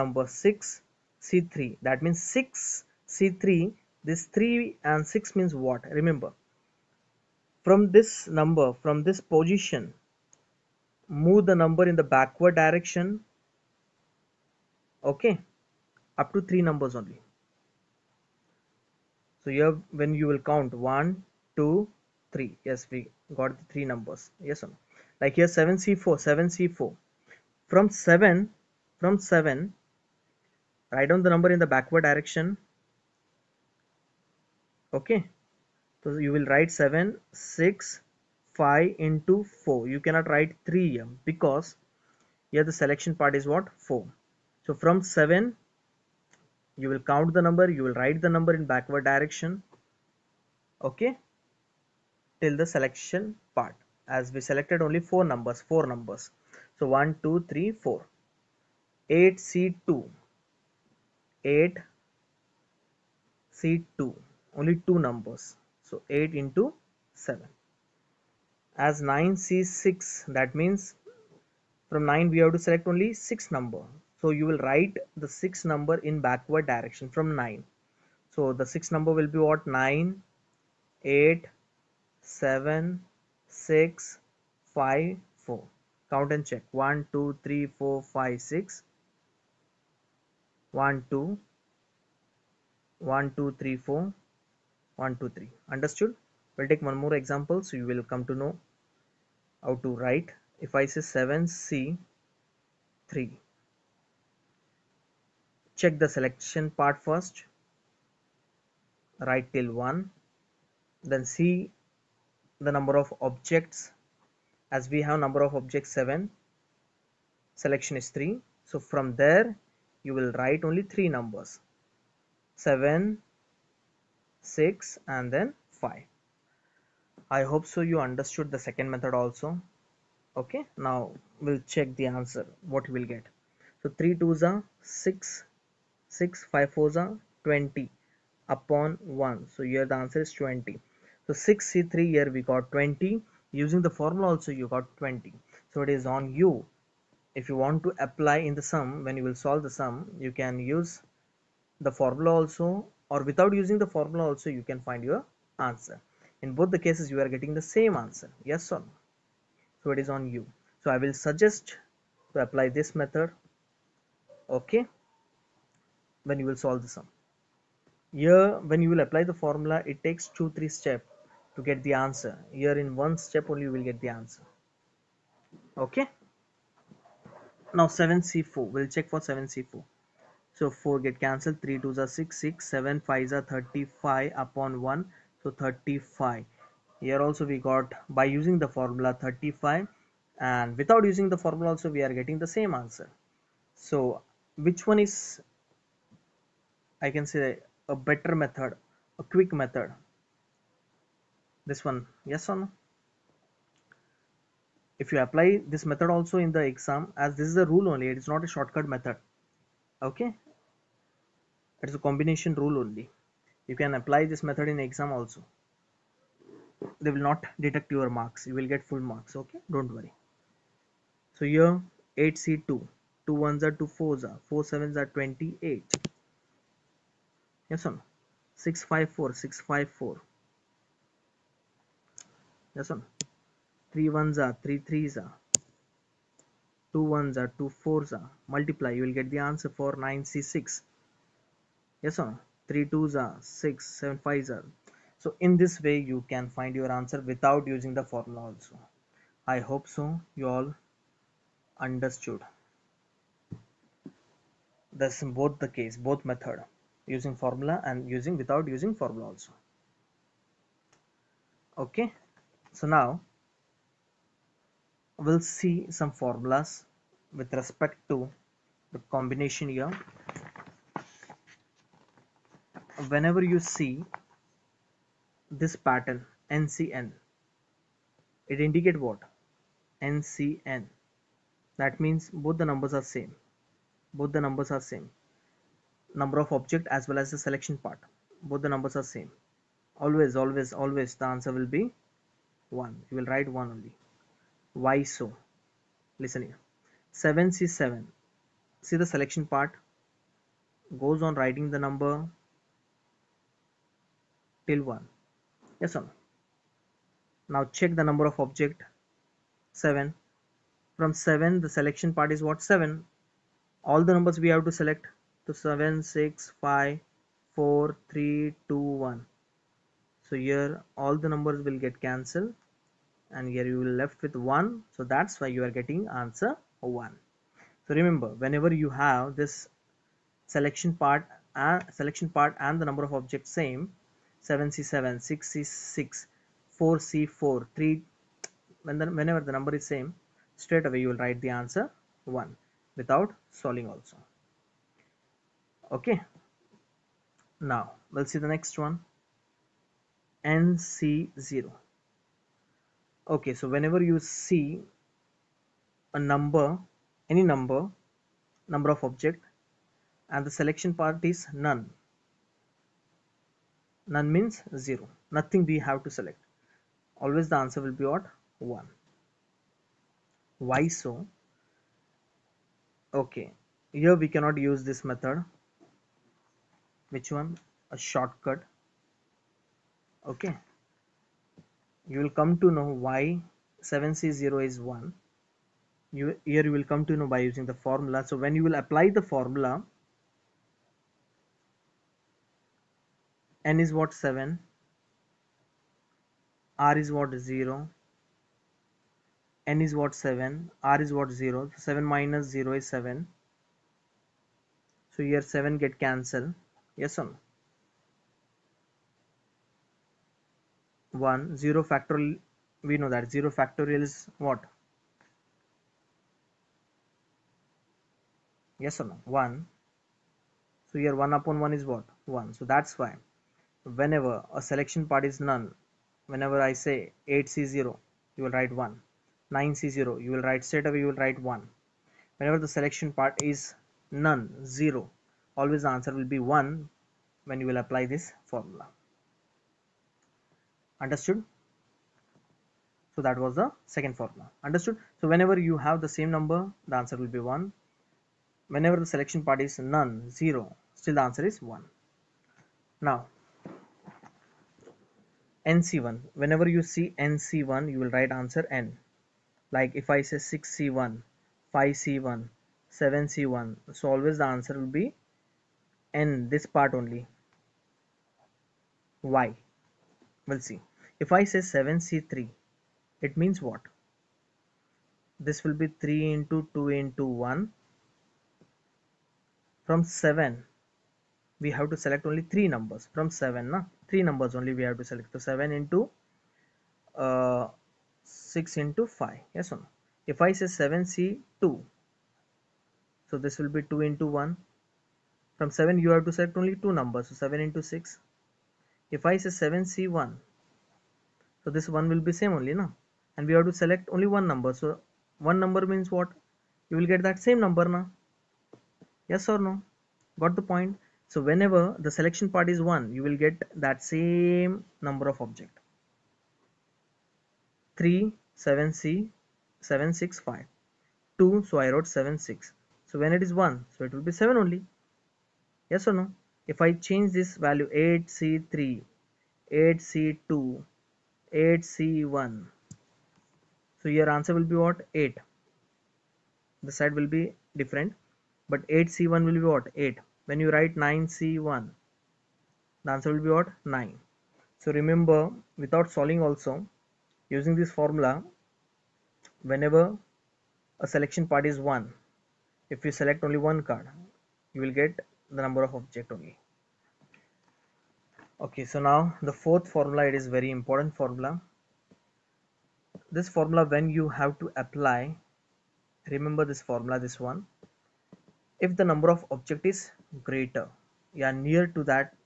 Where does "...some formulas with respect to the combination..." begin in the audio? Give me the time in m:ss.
4:25.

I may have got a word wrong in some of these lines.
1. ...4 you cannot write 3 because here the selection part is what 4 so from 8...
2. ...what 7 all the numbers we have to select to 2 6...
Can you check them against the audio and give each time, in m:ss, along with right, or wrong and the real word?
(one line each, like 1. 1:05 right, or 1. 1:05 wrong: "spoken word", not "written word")
1. 0:39 wrong: "7", not "8"
2. 5:12 wrong: "7", not "2".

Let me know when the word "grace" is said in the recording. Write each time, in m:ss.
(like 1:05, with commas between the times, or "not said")
not said.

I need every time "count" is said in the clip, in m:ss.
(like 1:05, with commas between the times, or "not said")
0:20, 0:47, 1:26.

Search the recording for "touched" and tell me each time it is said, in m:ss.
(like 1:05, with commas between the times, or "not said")
not said.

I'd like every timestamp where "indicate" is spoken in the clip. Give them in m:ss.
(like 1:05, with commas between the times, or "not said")
4:38.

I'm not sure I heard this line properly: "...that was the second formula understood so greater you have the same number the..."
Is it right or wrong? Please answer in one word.
wrong.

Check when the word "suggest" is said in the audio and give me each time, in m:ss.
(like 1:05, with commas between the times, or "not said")
2:41.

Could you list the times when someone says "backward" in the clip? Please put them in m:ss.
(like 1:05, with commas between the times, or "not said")
0:12, 0:31, 0:48, 1:16.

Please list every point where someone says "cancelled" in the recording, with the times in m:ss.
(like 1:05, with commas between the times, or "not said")
3:01, 5:22, 6:46.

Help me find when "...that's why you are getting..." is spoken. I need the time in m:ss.
5:25.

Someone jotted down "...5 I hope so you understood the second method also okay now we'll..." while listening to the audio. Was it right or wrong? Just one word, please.
right.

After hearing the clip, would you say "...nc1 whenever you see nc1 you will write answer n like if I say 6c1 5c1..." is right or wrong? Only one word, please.
right.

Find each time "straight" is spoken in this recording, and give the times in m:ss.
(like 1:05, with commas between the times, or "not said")
5:40, 7:10.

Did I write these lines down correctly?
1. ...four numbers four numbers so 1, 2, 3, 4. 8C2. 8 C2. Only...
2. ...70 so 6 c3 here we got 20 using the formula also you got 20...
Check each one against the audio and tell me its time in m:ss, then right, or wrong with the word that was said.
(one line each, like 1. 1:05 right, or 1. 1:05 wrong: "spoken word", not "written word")
1. 0:55 right
2. 2:20 wrong: "20", not "70".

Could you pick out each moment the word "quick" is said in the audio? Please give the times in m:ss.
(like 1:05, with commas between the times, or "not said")
3:19.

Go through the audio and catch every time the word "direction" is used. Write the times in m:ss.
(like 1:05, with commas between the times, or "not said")
0:12, 0:32, 0:49, 1:16.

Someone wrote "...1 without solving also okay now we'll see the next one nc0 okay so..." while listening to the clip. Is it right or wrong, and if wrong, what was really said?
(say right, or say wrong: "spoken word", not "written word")
right.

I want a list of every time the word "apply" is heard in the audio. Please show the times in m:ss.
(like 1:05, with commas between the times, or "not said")
2:27, 2:42, 2:49, 3:25, 3:33, 6:28, 7:17, 9:24.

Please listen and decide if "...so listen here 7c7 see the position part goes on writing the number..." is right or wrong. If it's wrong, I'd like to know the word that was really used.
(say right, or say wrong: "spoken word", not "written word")
wrong: "selection", not "position".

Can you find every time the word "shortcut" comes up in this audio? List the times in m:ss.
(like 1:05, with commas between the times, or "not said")
3:28, 6:17.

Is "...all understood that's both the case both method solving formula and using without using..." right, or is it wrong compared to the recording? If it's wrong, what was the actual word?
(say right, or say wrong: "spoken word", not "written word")
wrong: "using", not "solving".